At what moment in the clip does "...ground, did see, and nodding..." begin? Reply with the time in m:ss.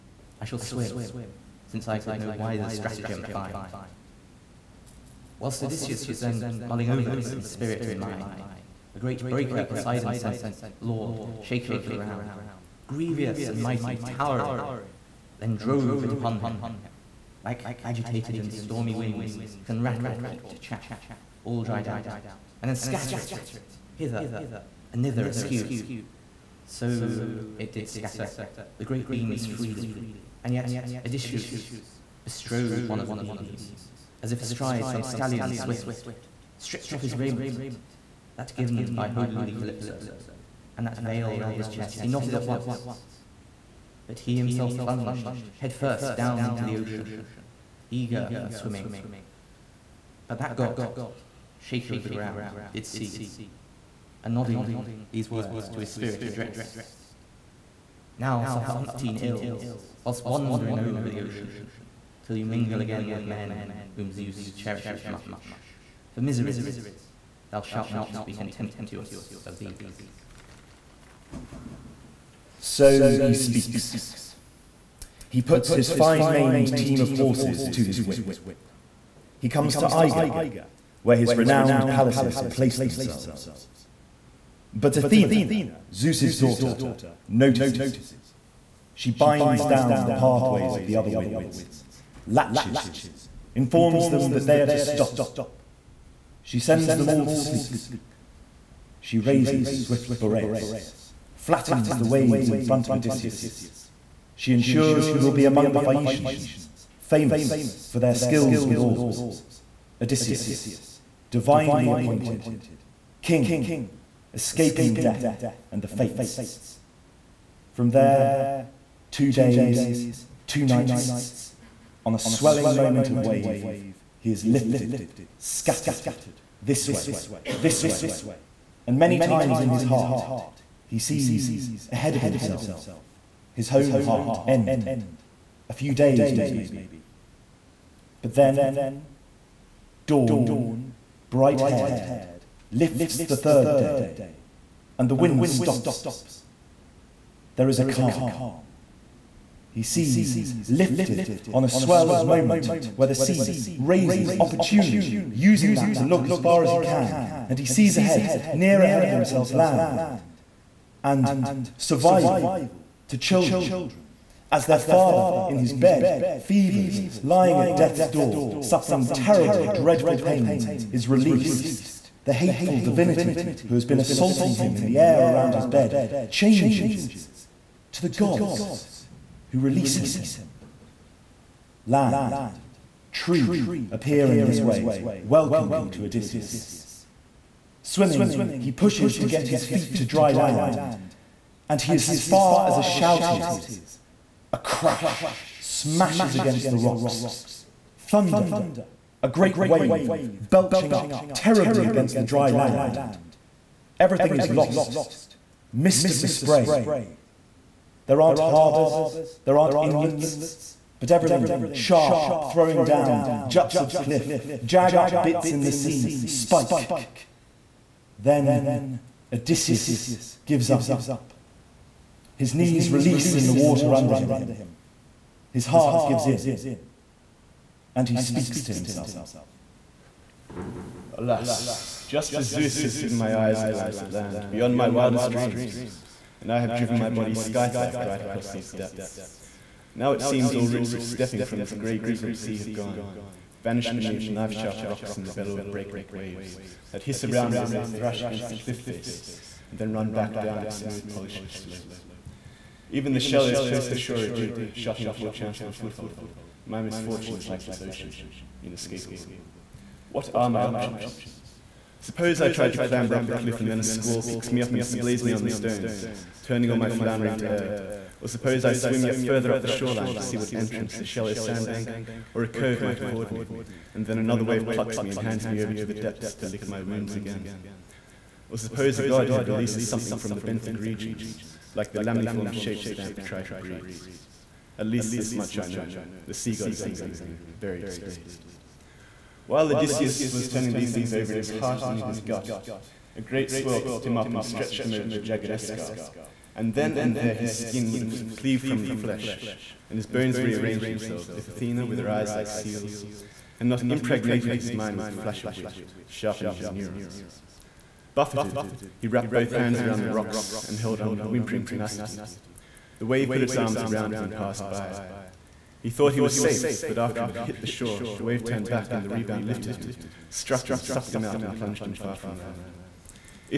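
0:52.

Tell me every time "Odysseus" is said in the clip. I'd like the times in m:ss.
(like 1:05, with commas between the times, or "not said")
0:05, 0:31, 1:42, 1:50, 3:06, 3:39, 4:49.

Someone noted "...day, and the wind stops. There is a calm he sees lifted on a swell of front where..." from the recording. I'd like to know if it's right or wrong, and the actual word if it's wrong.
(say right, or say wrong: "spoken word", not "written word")
wrong: "moment", not "front".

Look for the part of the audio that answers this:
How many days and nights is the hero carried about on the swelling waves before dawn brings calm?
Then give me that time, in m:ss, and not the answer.
1:59.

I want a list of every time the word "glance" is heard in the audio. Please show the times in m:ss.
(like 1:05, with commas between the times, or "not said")
3:53.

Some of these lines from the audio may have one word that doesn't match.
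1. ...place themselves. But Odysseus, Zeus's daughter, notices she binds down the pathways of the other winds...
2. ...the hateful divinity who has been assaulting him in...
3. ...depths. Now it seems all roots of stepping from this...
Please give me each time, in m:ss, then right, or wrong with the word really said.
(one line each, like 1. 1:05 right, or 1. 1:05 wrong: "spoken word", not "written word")
1. 1:22 wrong: "Athena", not "Odysseus"
2. 2:52 right
3. 3:58 right.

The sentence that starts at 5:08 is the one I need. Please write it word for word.
Buffeted, he wrapped both hands around the rocks and held on with whimpering tenacity.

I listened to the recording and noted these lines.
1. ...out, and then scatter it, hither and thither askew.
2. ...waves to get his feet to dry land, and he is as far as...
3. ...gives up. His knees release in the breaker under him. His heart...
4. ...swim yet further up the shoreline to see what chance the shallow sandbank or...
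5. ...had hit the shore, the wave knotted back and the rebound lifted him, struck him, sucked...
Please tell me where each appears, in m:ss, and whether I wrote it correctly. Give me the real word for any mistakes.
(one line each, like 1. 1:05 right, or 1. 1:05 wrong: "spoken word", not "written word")
1. 0:21 right
2. 3:08 wrong: "pushes", not "waves"
3. 3:40 wrong: "water", not "breaker"
4. 4:28 wrong: "entrance", not "chance"
5. 5:17 wrong: "turned", not "knotted".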